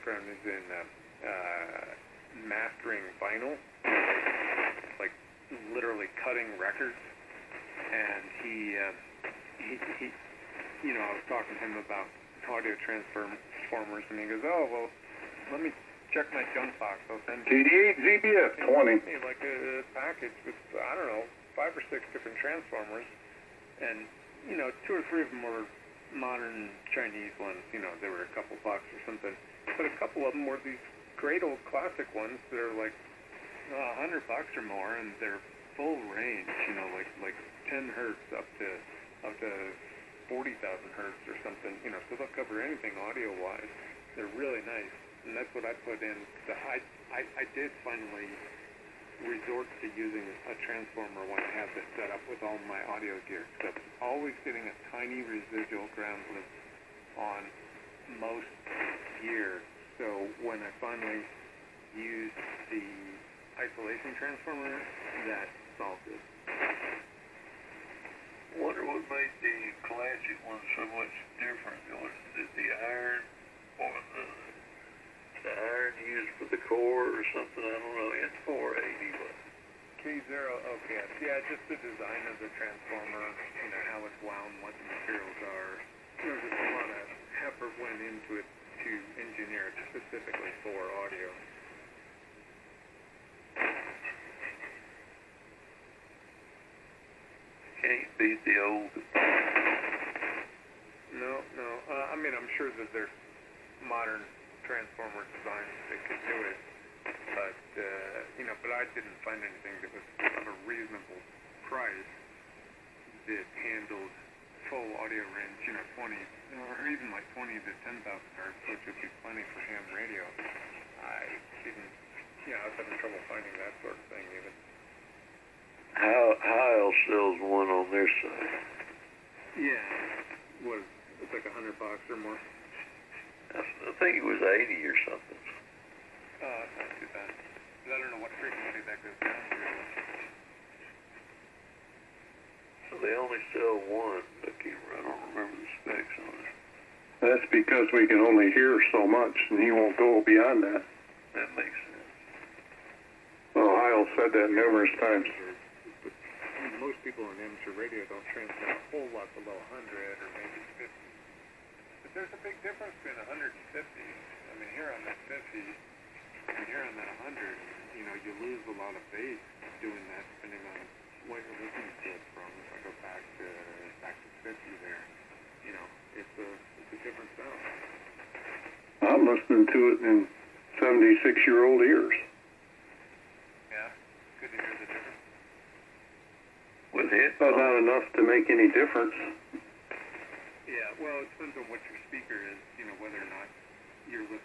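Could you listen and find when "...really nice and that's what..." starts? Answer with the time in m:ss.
0:44.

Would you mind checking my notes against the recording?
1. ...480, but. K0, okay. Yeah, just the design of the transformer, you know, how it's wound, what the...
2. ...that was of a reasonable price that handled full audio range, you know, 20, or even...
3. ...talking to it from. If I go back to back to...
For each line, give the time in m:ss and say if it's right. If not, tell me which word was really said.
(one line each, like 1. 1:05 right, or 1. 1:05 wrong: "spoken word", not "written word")
1. 1:18 right
2. 1:49 right
3. 2:51 wrong: "looking", not "talking".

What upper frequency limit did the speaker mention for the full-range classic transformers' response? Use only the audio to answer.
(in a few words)
40,000 hertz.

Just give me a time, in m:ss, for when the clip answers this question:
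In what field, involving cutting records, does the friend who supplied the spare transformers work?
0:02.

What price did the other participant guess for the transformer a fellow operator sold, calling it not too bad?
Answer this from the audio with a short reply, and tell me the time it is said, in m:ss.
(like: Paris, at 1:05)
80, at 2:14.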